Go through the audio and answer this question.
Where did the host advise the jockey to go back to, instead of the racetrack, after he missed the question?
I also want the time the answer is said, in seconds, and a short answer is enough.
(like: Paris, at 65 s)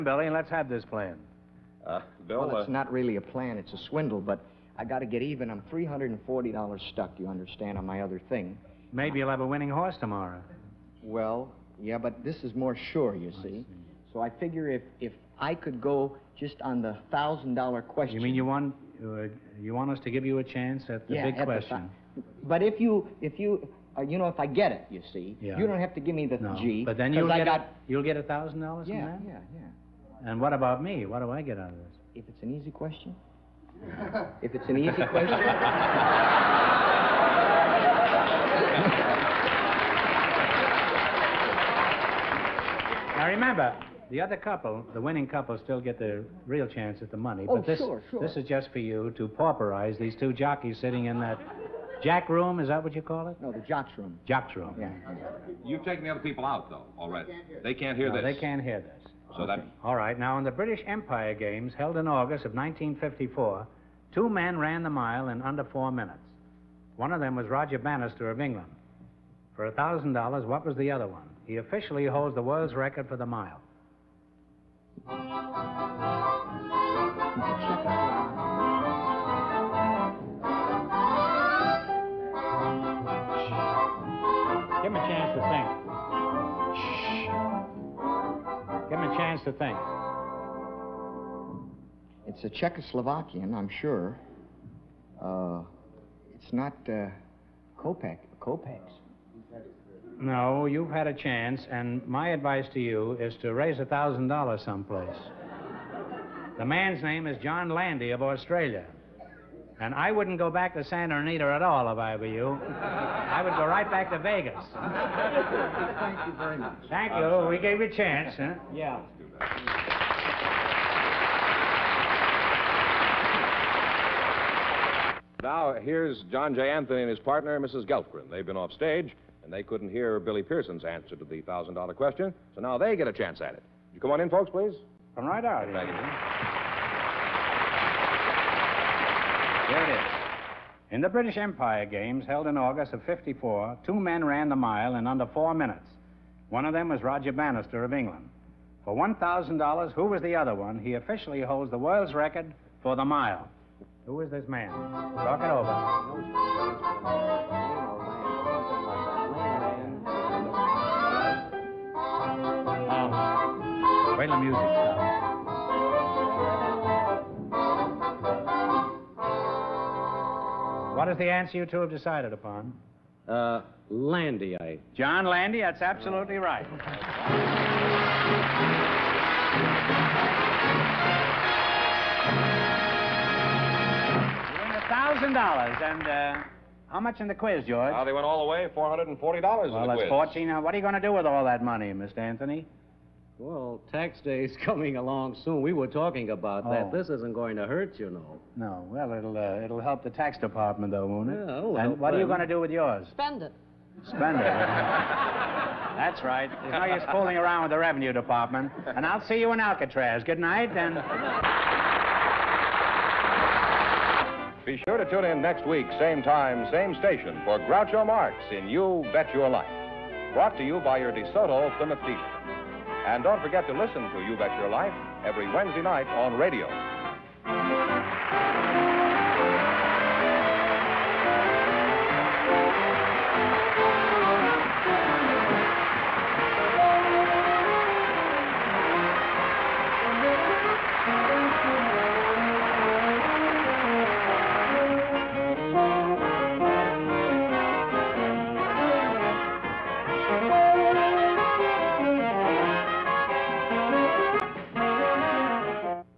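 Vegas, at 114 s.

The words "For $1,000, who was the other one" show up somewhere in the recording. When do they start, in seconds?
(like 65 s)
148 s.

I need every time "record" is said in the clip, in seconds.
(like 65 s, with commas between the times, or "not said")
72 s, 152 s.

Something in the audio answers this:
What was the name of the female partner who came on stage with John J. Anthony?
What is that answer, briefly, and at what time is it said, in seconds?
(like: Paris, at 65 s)
Mrs. Gelfgren, at 127 s.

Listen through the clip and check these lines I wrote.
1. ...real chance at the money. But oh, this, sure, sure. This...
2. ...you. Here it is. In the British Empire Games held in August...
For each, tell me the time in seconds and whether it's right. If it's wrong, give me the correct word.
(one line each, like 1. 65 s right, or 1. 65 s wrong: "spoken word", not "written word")
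1. 46 s right
2. 135 s right.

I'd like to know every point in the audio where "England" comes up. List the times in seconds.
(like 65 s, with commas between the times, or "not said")
68 s, 147 s.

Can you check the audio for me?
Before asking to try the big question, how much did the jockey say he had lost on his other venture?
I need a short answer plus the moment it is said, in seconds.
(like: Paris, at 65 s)
$340, at 5 s.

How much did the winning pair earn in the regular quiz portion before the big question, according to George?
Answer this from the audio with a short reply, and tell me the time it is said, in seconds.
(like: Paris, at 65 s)
$440, at 188 s.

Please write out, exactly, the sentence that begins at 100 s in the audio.
No, you've had a chance, and my advice to you is to raise a $1,000 someplace.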